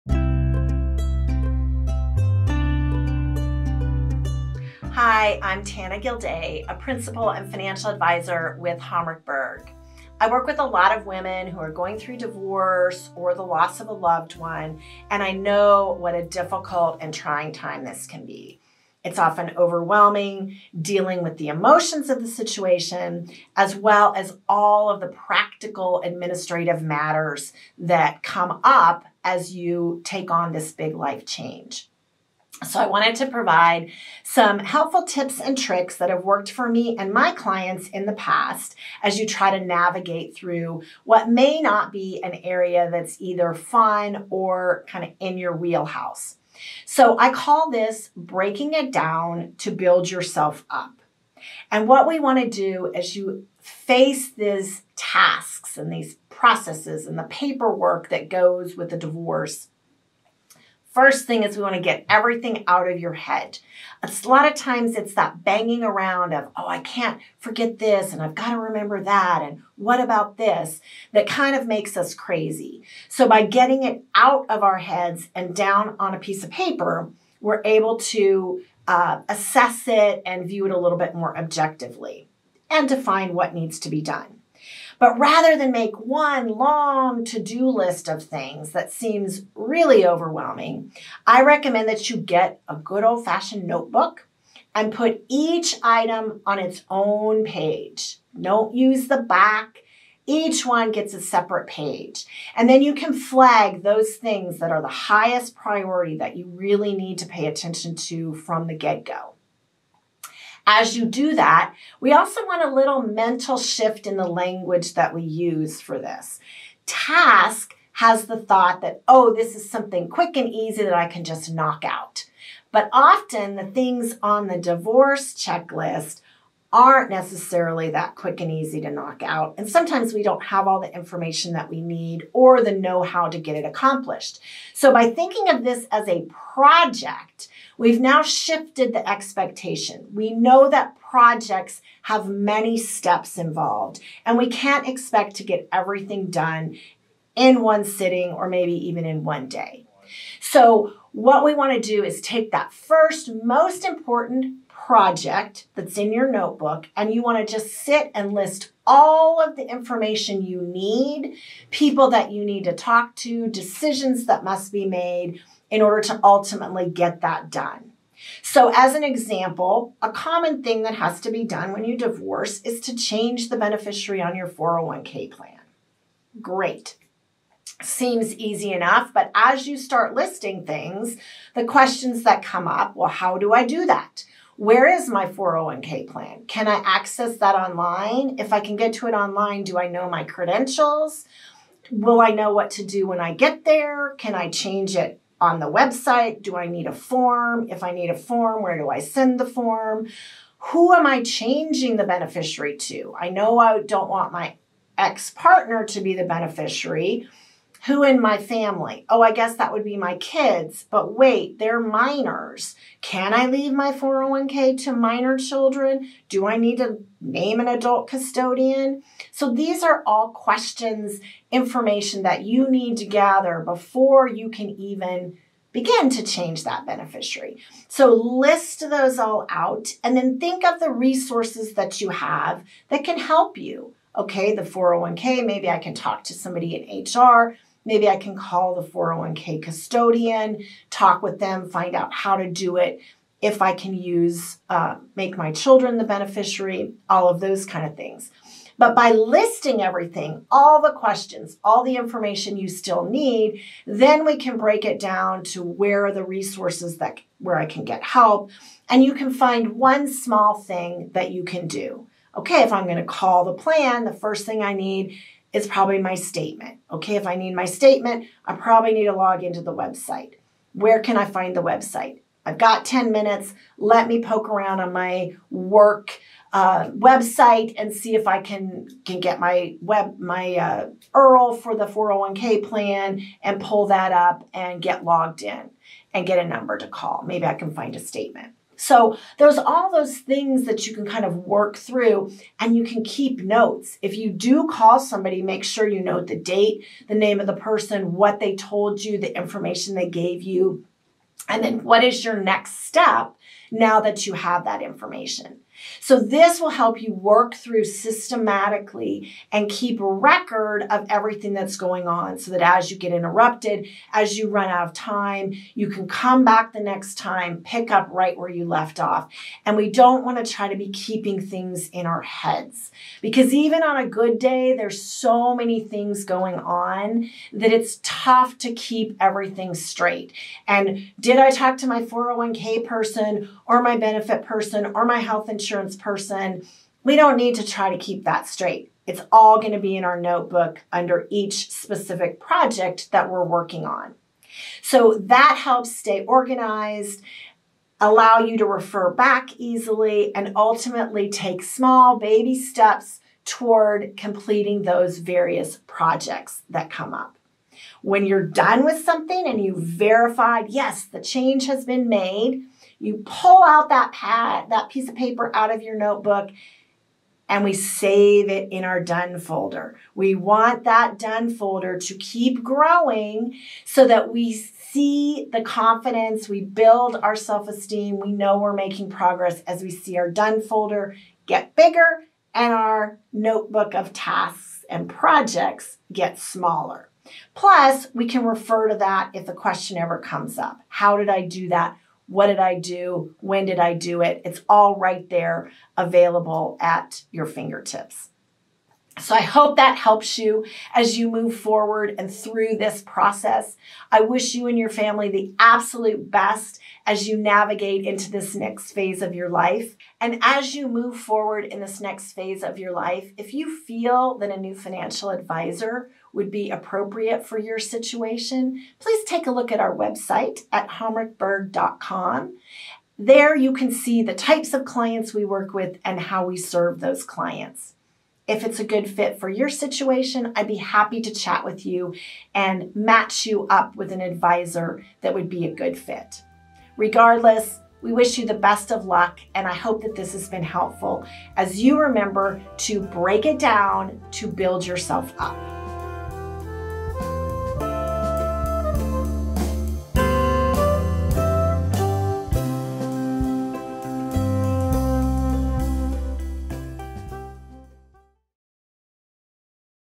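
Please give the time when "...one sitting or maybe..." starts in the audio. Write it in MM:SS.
02:27.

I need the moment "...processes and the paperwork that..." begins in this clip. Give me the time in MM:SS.
00:56.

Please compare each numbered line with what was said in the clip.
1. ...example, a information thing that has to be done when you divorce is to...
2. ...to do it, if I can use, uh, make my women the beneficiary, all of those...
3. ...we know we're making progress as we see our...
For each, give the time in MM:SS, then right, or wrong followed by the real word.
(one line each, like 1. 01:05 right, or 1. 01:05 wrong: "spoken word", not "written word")
1. 02:49 wrong: "common", not "information"
2. 04:02 wrong: "children", not "women"
3. 06:18 right.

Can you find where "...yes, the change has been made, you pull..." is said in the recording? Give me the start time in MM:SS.
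06:00.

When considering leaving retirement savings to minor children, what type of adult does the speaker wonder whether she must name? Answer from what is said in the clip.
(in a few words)
adult custodian.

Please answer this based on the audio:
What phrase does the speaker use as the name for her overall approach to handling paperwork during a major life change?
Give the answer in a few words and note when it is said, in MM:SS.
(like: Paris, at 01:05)
breaking it down to build yourself up, at 00:48.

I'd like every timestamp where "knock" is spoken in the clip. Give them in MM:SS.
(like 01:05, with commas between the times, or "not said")
02:01, 02:08.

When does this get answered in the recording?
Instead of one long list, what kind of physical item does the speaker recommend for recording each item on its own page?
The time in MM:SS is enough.
01:32.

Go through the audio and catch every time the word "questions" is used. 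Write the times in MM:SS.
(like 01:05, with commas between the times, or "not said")
03:01, 03:40, 04:10, 06:29.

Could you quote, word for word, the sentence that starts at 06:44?
I wish you and your family the absolute best as you navigate into this next phase of your life.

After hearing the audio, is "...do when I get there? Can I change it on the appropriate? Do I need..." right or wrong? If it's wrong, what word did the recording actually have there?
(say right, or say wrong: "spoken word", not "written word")
wrong: "website", not "appropriate".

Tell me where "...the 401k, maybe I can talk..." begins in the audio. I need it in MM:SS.
03:54.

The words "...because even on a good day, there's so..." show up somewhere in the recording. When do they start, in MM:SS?
05:23.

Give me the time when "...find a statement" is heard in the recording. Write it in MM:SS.
04:47.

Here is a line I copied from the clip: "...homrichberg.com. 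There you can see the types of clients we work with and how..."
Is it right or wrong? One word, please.
right.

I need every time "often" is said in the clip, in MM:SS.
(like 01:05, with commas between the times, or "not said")
00:19, 02:02.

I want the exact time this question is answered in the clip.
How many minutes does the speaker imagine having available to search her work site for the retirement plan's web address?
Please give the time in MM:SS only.
04:32.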